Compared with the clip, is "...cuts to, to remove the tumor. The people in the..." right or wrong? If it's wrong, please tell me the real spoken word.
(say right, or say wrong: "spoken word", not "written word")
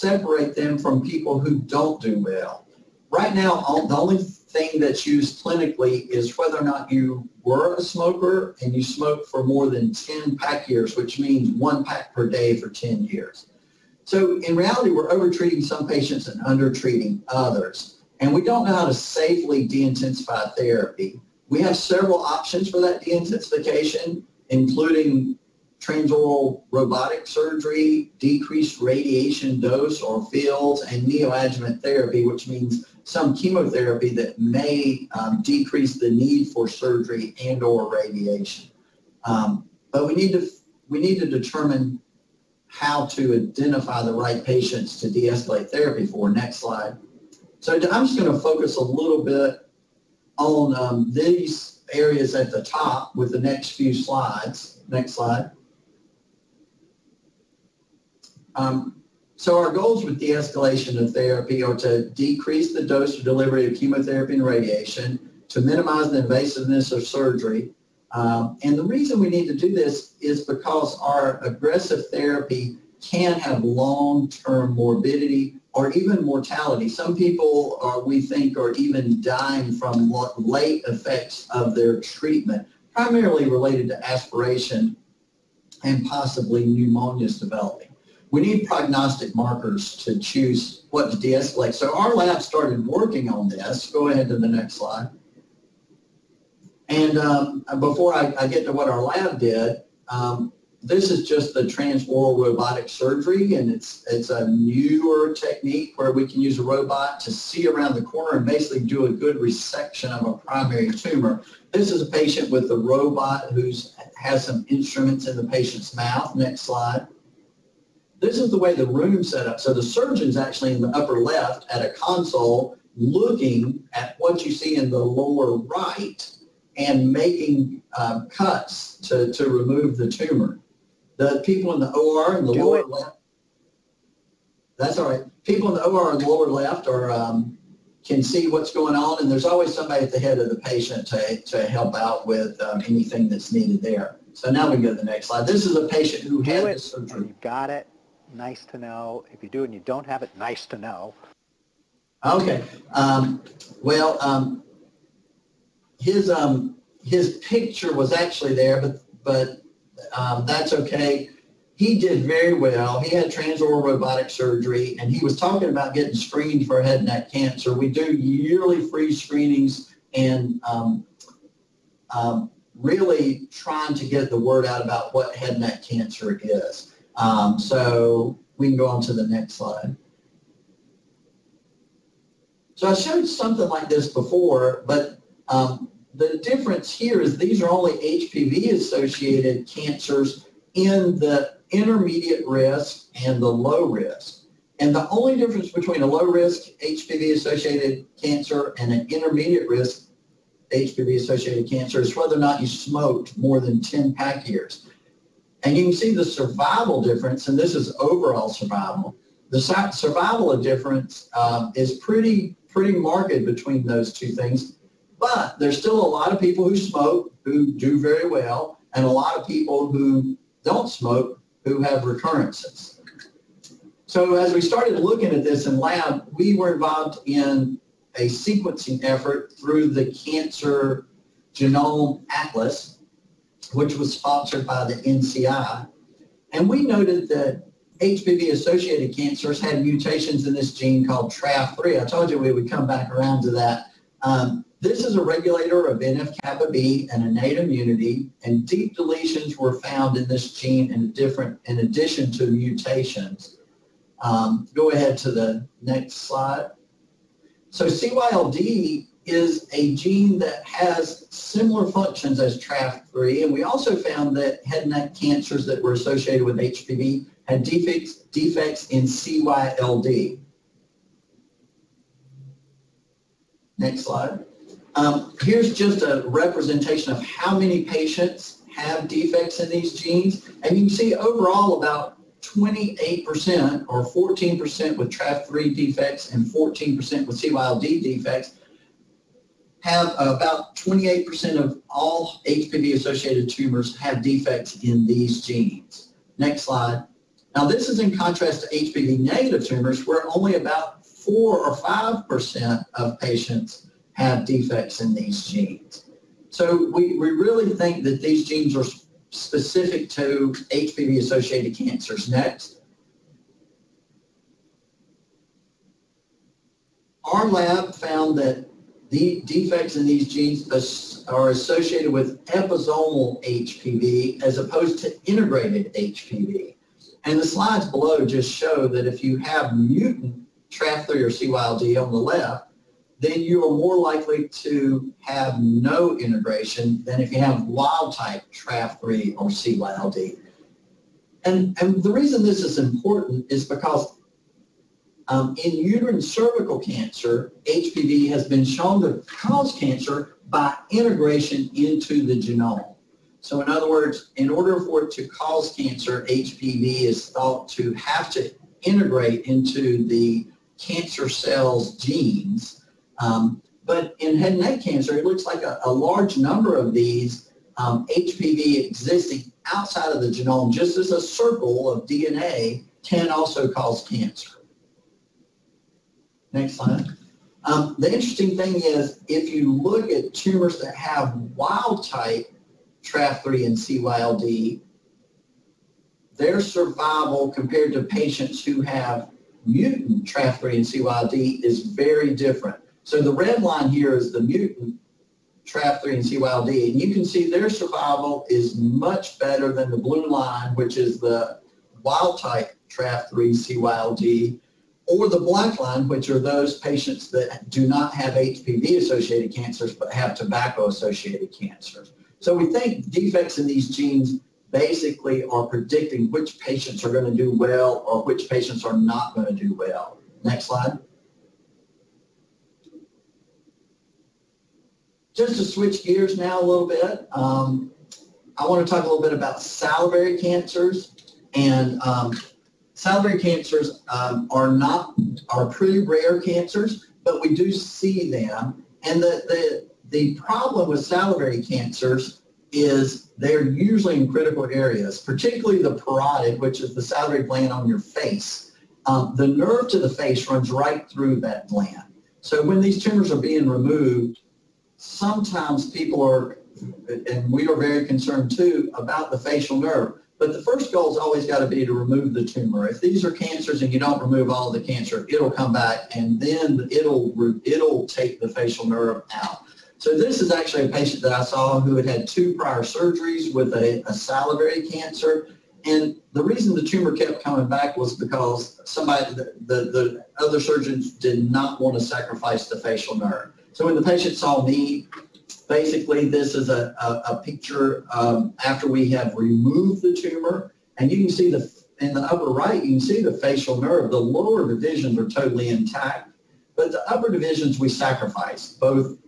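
right.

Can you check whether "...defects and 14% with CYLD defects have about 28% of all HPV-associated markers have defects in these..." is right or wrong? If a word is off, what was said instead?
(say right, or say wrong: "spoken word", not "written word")
wrong: "tumors", not "markers".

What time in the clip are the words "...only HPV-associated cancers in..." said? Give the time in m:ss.
3:07.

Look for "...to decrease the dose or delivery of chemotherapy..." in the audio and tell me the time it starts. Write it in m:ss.
1:01.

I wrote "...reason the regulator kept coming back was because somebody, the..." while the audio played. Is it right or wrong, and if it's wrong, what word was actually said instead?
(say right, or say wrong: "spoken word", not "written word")
wrong: "tumor", not "regulator".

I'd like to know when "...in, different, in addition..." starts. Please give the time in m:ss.
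4:10.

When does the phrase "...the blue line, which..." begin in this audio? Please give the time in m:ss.
6:39.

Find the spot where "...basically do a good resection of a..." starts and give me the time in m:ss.
1:48.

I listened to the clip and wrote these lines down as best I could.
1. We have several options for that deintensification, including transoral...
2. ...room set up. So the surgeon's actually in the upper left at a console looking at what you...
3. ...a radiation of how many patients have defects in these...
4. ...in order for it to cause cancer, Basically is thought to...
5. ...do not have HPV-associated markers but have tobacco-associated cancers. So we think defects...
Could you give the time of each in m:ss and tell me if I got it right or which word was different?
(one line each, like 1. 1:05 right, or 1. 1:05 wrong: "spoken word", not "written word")
1. 0:21 right
2. 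1:58 right
3. 4:36 wrong: "representation", not "radiation"
4. 5:54 wrong: "HPV", not "Basically"
5. 6:47 wrong: "cancers", not "markers".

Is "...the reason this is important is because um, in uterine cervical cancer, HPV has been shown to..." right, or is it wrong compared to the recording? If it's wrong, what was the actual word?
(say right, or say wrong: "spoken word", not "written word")
right.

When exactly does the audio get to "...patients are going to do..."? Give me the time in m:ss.
6:56.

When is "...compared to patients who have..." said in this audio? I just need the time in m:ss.
6:27.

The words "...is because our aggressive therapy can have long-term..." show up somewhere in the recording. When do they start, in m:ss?
1:10.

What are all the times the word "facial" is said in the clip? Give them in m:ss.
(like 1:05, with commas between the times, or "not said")
7:39, 7:48, 8:02, 8:13.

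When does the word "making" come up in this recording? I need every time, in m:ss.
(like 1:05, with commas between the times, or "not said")
2:07.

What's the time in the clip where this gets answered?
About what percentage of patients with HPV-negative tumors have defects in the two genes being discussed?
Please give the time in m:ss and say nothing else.
5:01.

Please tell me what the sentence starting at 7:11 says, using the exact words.
And um, Salivary cancers um, are not are pretty rare cancers, but we do see them.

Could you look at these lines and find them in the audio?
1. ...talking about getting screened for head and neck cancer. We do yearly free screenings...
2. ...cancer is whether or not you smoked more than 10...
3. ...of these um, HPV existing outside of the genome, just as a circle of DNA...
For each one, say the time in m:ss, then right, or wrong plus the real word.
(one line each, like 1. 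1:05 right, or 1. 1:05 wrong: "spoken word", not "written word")
1. 2:45 right
2. 3:21 right
3. 6:06 right.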